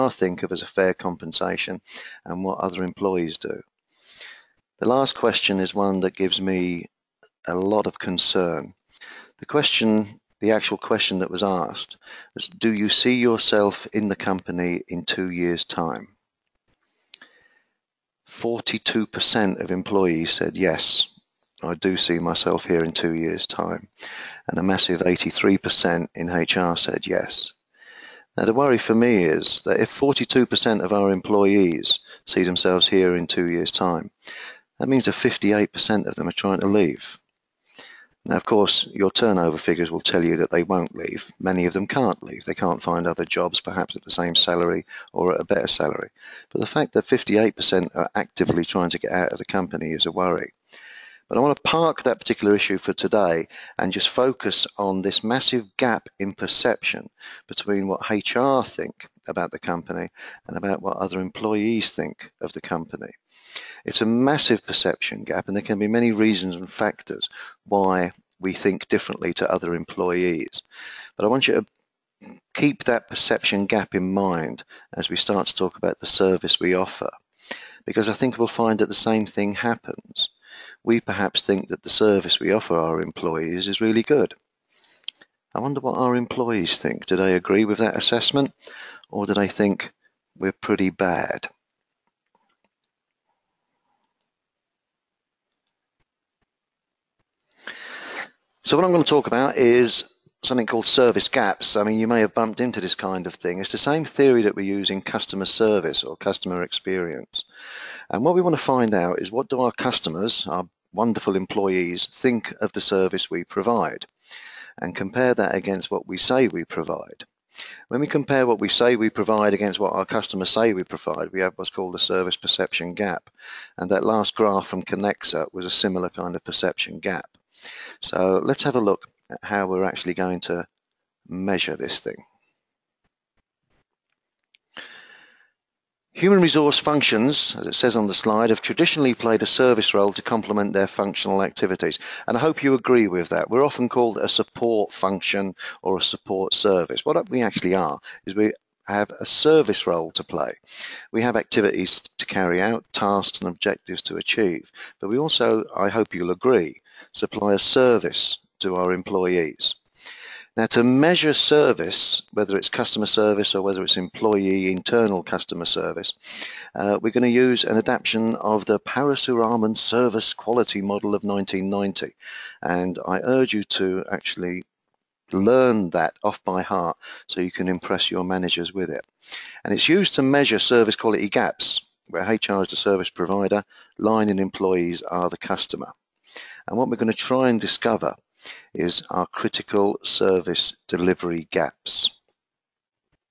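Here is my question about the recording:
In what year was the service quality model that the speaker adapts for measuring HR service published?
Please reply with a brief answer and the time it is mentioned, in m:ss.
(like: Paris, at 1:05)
1990, at 2:51.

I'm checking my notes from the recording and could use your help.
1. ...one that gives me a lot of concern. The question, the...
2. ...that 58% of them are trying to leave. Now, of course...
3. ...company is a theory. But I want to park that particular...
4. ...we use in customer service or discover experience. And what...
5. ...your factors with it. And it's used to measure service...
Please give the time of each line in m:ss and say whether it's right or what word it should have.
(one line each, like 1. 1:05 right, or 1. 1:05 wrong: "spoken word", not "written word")
1. 0:05 right
2. 0:35 right
3. 0:49 wrong: "worry", not "theory"
4. 1:44 wrong: "customer", not "discover"
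5. 2:58 wrong: "managers", not "factors".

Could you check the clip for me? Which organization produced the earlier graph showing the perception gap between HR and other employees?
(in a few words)
Kenexa.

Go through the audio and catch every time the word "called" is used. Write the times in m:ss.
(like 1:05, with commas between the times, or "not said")
1:40, 2:01, 2:23.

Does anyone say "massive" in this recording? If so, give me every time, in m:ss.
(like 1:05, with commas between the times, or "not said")
0:24, 0:55, 1:04.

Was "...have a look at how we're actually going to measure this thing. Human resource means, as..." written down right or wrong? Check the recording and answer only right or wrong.
wrong.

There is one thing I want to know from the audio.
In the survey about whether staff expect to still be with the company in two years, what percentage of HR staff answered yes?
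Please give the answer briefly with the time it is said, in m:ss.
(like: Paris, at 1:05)
83%, at 0:24.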